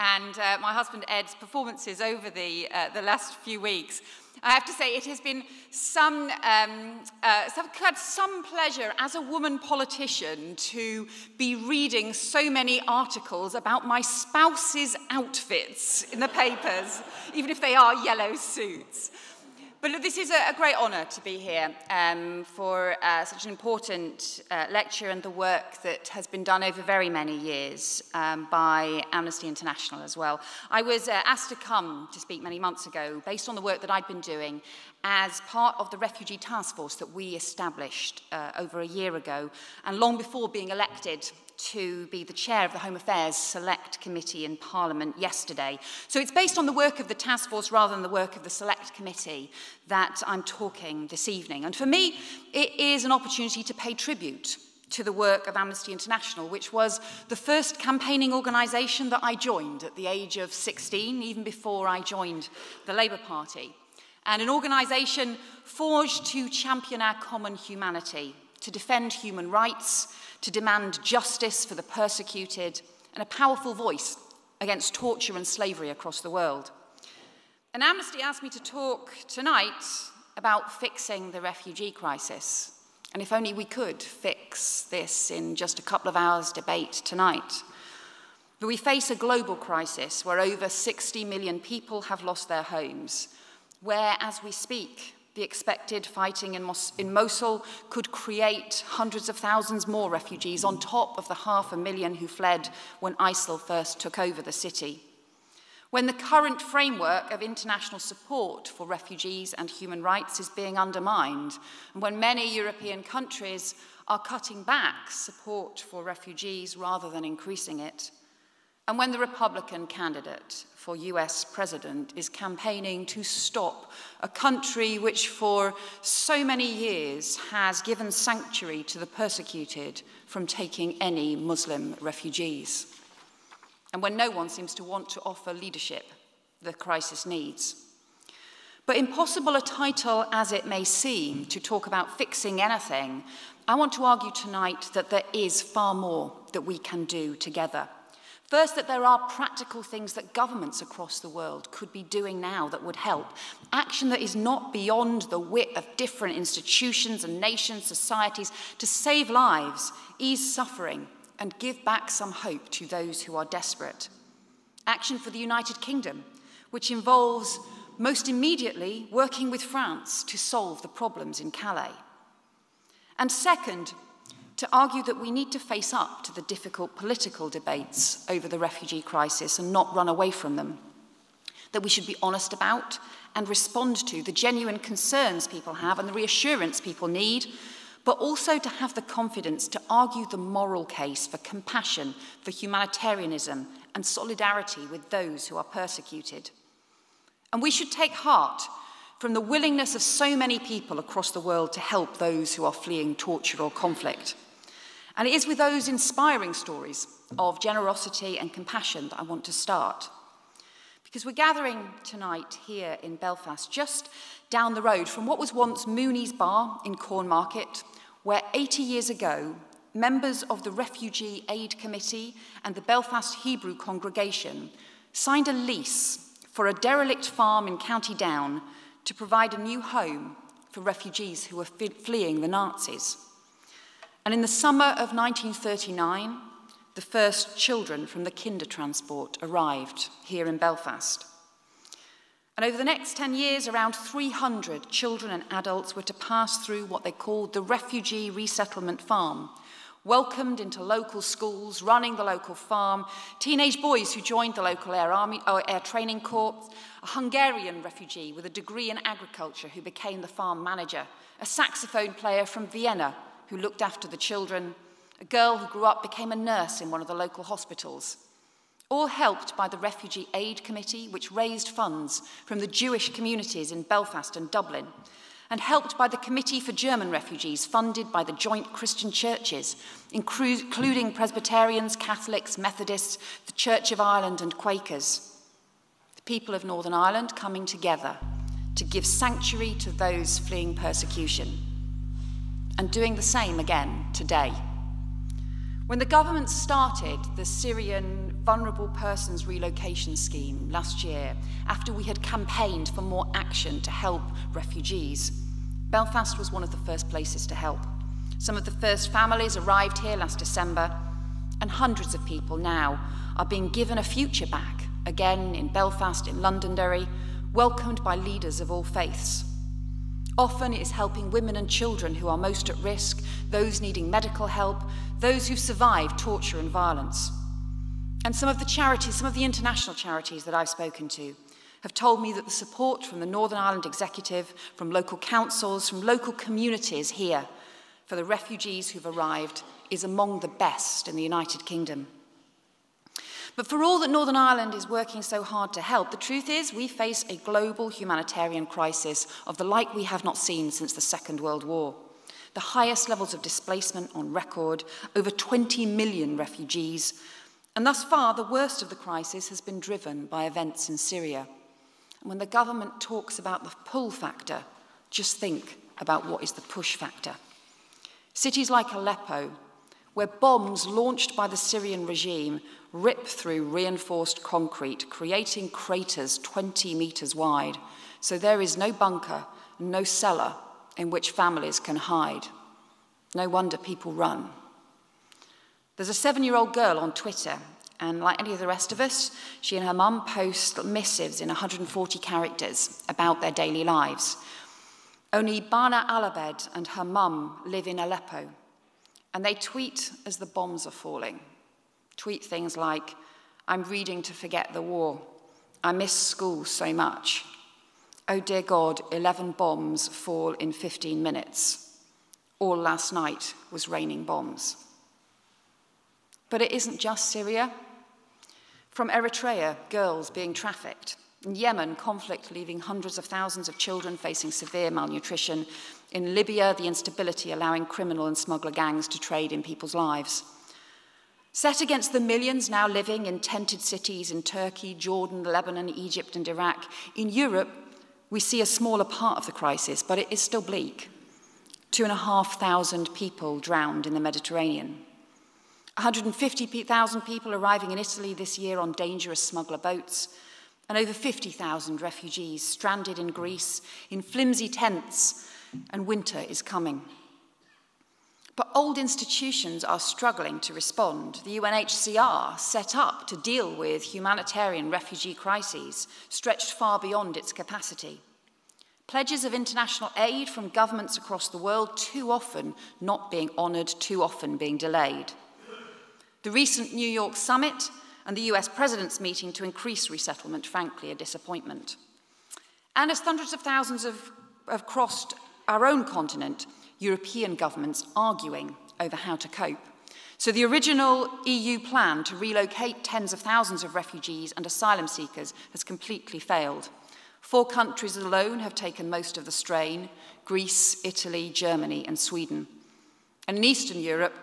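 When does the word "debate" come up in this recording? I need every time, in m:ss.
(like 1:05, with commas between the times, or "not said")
1:26, 2:57.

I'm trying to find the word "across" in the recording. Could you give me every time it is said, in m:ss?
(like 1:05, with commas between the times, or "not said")
1:15, 2:30, 3:20, 7:51.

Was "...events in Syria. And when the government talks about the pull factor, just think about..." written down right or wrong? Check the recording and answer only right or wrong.
right.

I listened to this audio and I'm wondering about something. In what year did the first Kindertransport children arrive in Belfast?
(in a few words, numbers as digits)
1939.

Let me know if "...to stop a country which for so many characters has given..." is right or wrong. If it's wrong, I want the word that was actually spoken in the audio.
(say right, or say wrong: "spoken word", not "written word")
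wrong: "years", not "characters".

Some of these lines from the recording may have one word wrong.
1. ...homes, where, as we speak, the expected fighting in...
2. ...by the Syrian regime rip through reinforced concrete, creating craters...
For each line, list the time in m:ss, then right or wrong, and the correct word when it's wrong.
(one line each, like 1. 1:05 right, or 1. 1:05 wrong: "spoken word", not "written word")
1. 1:32 right
2. 6:11 right.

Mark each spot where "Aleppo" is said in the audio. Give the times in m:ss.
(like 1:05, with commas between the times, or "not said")
6:08, 6:37.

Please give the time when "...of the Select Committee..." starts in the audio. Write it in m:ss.
0:48.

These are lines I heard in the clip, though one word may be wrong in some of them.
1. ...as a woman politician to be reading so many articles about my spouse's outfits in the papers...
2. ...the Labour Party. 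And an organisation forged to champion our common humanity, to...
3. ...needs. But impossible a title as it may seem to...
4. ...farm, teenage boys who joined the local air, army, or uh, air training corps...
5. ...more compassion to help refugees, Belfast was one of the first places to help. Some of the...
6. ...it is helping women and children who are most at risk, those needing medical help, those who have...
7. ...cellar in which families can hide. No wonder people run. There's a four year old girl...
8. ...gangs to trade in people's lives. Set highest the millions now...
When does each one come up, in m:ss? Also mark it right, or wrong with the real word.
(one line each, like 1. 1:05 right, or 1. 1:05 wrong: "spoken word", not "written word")
1. 0:08 right
2. 1:02 right
3. 2:17 right
4. 4:12 right
5. 5:03 wrong: "action", not "compassion"
6. 5:20 right
7. 6:20 wrong: "seven", not "four"
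8. 7:08 wrong: "against", not "highest".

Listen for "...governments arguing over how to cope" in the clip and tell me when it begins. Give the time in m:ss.
8:07.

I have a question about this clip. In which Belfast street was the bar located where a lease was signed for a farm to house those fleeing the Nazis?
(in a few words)
Cornmarket.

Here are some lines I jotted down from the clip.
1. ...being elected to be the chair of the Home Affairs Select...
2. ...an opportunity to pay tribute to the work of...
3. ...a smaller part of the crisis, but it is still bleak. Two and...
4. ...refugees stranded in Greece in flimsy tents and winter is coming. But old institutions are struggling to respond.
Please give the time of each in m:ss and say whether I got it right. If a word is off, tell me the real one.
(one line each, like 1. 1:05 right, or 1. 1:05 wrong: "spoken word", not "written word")
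1. 0:40 right
2. 0:53 right
3. 7:18 right
4. 7:32 right.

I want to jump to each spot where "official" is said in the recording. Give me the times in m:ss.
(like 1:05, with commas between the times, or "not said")
not said.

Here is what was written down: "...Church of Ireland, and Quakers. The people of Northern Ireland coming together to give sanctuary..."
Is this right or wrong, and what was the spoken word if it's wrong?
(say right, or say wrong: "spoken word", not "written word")
right.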